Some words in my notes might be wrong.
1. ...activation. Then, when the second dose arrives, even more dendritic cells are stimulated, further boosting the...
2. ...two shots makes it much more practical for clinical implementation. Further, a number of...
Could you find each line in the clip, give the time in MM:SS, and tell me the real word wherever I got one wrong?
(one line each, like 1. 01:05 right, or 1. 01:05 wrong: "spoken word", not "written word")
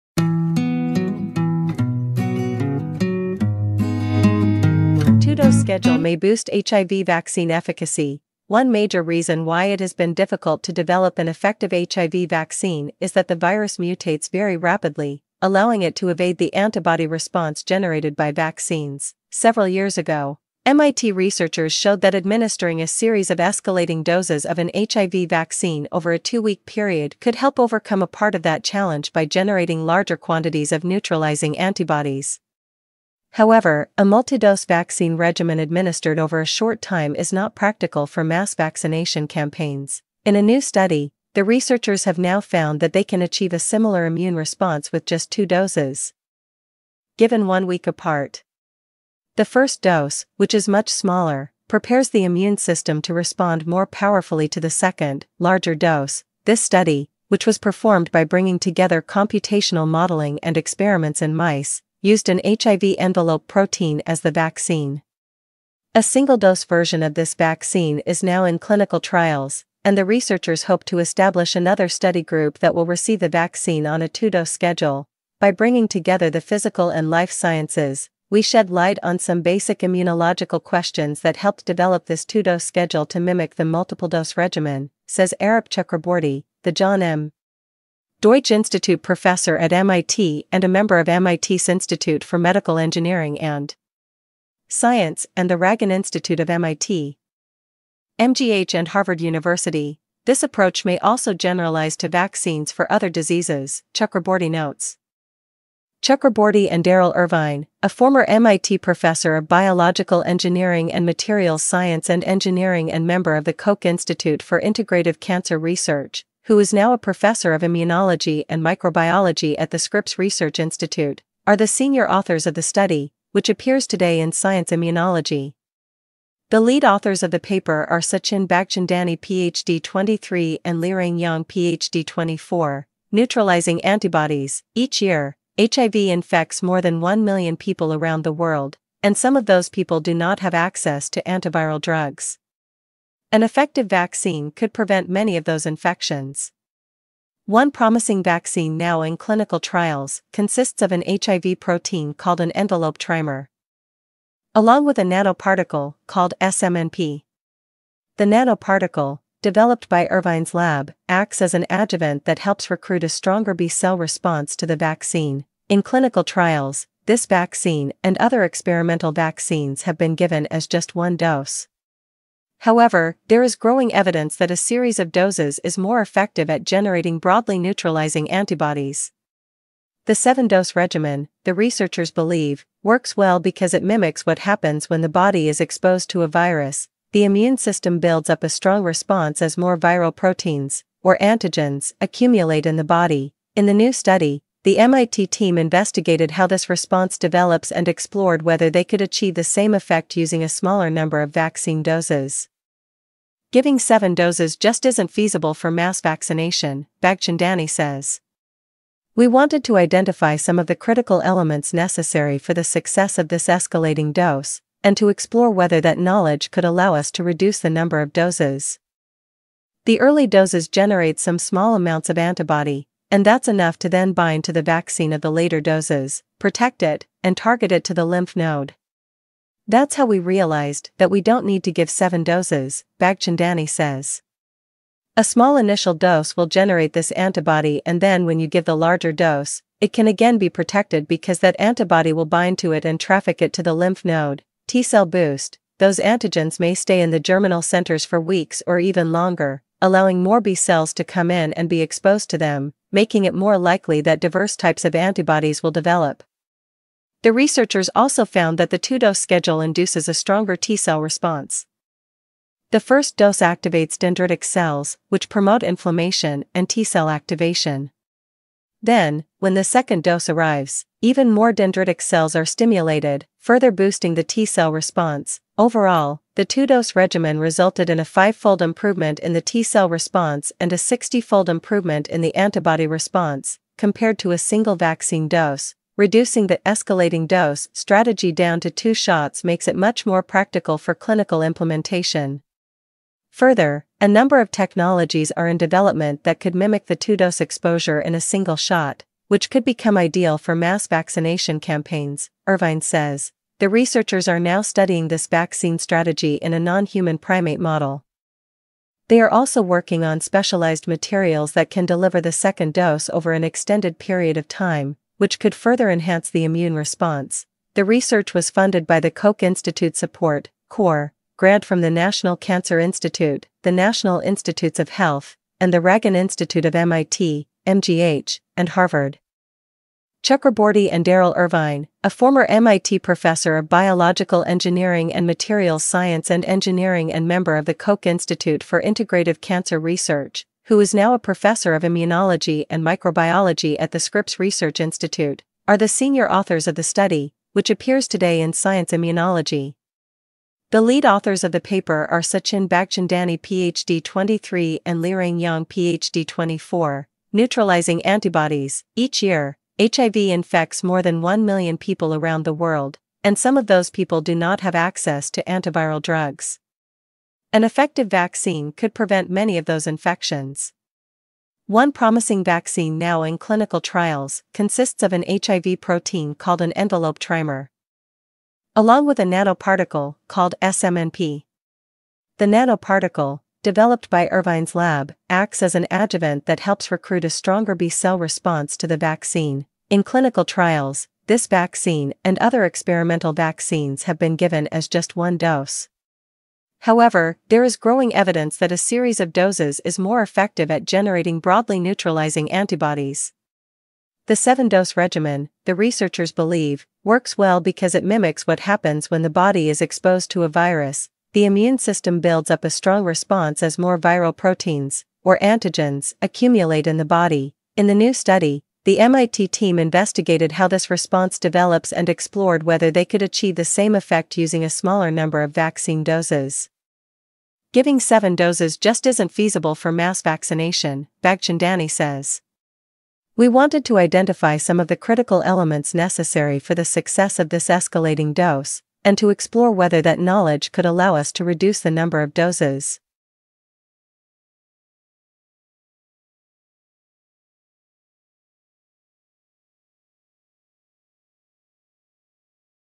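1. 04:27 right
2. 04:48 right.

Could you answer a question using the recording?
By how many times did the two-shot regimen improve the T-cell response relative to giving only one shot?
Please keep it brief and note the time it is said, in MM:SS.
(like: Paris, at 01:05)
5-fold, at 04:38.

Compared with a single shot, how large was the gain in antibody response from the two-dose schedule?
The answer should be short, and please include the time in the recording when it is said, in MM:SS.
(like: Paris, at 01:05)
60-fold, at 04:40.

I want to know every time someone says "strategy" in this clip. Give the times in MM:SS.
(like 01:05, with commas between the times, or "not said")
04:47, 05:05.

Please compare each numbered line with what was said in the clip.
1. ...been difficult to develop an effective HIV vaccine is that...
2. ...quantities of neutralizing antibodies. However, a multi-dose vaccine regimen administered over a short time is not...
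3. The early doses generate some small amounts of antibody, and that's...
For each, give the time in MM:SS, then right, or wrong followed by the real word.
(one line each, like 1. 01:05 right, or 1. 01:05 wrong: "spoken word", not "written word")
1. 00:09 right
2. 00:30 right
3. 03:39 right.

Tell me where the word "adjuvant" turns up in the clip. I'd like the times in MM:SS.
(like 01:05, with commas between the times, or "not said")
02:41, 06:25.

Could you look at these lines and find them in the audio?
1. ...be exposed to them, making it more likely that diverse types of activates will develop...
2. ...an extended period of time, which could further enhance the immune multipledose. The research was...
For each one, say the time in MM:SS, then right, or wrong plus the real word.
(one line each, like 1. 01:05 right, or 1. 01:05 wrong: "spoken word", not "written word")
1. 04:11 wrong: "antibodies", not "activates"
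2. 05:13 wrong: "response", not "multipledose".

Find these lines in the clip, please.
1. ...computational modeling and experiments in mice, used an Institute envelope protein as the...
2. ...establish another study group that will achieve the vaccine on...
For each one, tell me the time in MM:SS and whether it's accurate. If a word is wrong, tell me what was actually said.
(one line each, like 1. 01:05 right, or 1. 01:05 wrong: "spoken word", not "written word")
1. 00:59 wrong: "HIV", not "Institute"
2. 01:10 wrong: "receive", not "achieve".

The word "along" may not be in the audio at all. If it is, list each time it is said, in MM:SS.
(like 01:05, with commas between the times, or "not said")
02:34, 06:18.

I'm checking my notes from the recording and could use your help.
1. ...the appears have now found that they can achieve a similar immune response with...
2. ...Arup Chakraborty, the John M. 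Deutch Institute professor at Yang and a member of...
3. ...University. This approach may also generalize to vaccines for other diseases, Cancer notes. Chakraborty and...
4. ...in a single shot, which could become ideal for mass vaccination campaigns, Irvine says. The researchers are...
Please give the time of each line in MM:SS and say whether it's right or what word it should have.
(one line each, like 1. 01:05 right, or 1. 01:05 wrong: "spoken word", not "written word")
1. 00:41 wrong: "researchers", not "appears"
2. 01:25 wrong: "MIT", not "Yang"
3. 01:39 wrong: "Chakraborty", not "Cancer"
4. 04:58 right.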